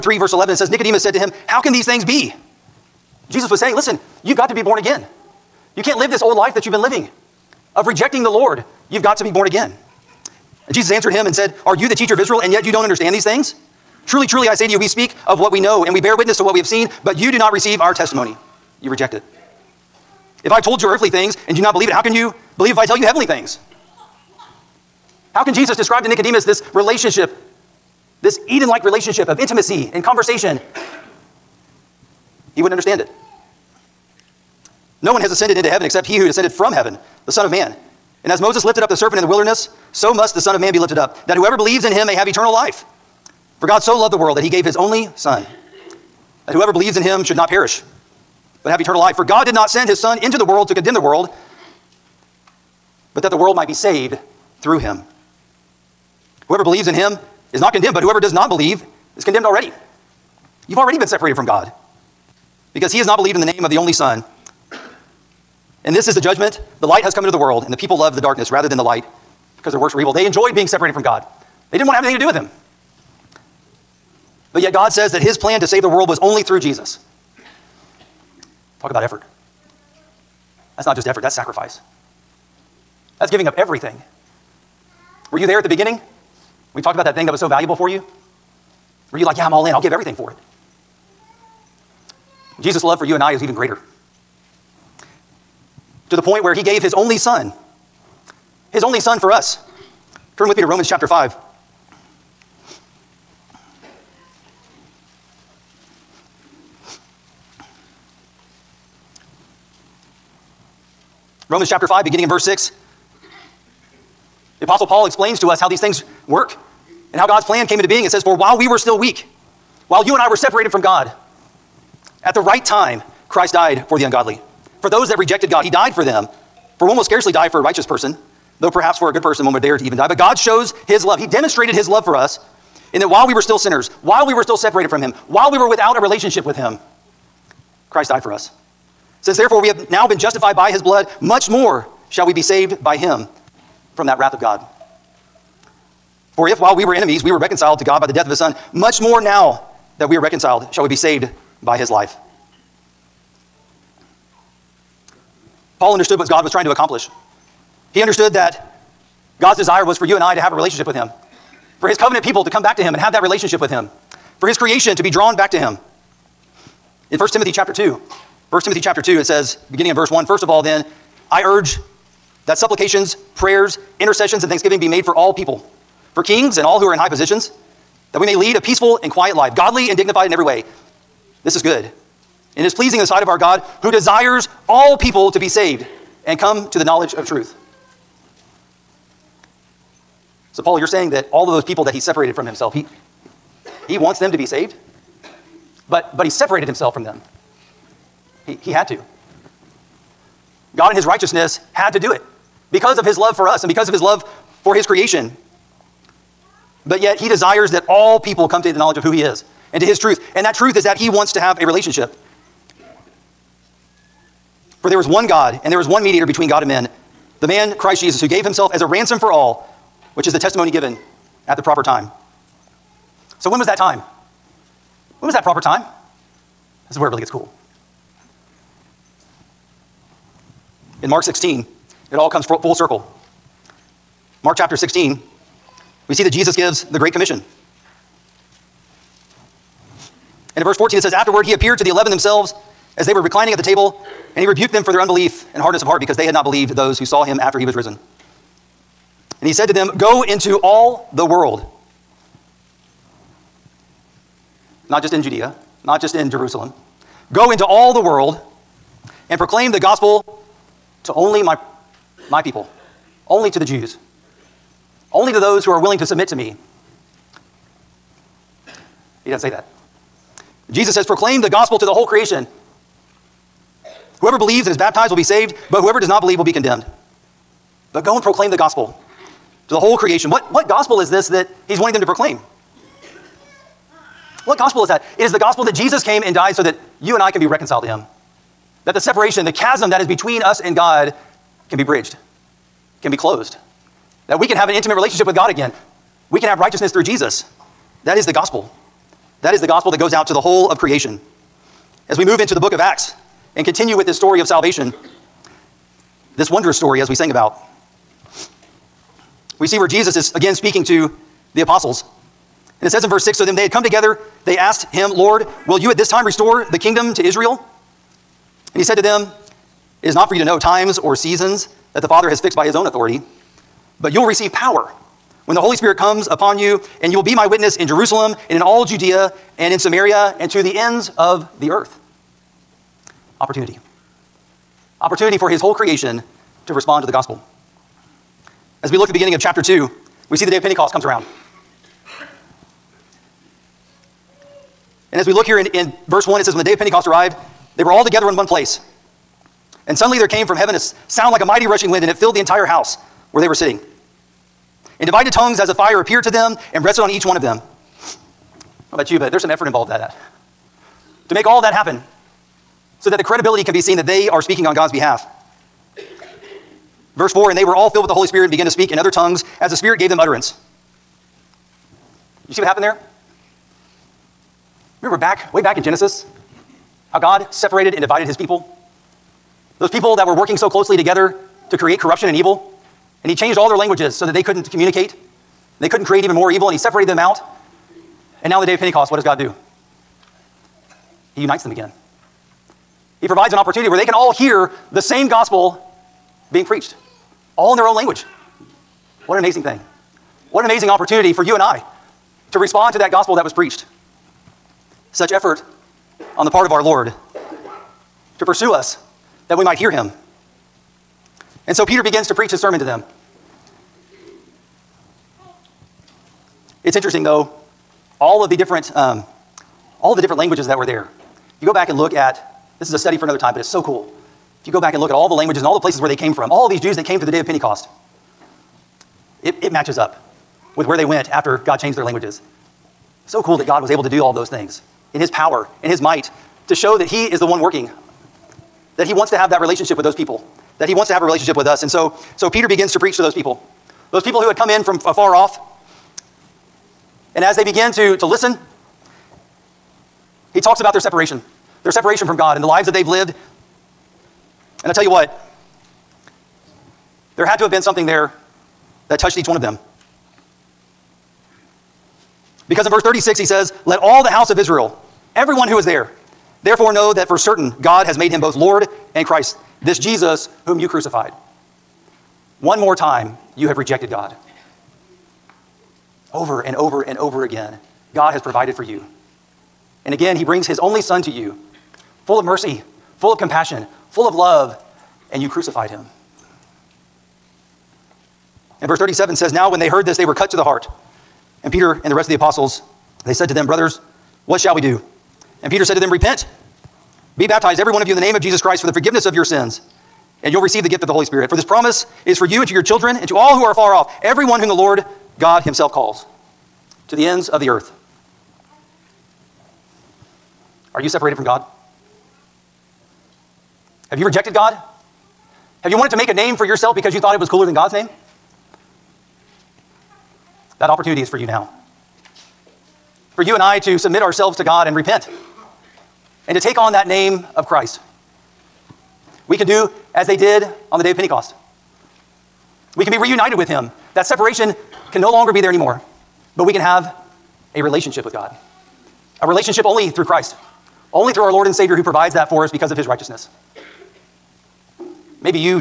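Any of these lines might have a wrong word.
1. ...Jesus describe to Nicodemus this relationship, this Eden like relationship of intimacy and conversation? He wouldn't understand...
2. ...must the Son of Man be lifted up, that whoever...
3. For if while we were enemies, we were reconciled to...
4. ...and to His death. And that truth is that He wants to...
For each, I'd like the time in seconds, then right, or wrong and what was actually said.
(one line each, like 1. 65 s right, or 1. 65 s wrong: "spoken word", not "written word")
1. 25 s right
2. 40 s right
3. 146 s right
4. 209 s wrong: "truth", not "death".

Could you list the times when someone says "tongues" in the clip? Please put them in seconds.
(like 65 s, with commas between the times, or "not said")
355 s, 369 s.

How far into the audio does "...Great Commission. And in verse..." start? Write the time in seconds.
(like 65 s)
236 s.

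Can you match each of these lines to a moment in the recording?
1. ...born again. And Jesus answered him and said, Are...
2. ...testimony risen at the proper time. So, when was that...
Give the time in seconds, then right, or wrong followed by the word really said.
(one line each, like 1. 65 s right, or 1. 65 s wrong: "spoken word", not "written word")
1. 9 s right
2. 220 s wrong: "given", not "risen".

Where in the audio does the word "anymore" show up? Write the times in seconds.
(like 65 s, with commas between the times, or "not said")
535 s.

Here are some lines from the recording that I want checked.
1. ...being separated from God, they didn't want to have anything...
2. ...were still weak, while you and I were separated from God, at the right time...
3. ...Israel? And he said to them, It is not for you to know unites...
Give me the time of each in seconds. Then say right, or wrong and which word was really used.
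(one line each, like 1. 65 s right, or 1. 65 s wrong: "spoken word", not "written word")
1. 70 s right
2. 118 s right
3. 317 s wrong: "times", not "unites".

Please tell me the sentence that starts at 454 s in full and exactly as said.
And I tell you what, there had to have been something there that touched each one of them.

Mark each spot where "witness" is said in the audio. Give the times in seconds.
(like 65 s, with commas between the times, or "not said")
16 s, 327 s.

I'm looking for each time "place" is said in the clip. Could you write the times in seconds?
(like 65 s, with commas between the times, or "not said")
348 s, 425 s.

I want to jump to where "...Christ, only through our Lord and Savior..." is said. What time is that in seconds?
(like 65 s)
540 s.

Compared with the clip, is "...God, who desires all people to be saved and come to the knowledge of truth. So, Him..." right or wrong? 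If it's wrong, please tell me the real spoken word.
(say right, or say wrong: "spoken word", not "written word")
wrong: "Paul", not "Him".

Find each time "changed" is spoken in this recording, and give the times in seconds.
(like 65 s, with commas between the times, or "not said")
383 s, 431 s.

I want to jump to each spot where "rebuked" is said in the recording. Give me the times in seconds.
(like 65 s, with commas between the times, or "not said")
244 s.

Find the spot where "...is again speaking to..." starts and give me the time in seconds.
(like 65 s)
310 s.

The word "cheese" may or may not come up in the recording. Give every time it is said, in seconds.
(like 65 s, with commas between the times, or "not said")
not said.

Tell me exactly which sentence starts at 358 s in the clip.
How about you, but there's some effort involved in that.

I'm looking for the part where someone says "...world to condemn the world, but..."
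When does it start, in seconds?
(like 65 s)
50 s.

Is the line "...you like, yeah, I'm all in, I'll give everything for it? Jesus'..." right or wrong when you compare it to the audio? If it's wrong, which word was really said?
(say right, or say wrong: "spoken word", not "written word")
right.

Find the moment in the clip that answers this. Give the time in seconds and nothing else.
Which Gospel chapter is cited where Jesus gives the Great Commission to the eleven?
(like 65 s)
231 s.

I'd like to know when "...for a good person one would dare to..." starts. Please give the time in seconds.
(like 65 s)
128 s.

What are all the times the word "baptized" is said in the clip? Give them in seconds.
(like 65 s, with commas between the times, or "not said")
274 s, 497 s.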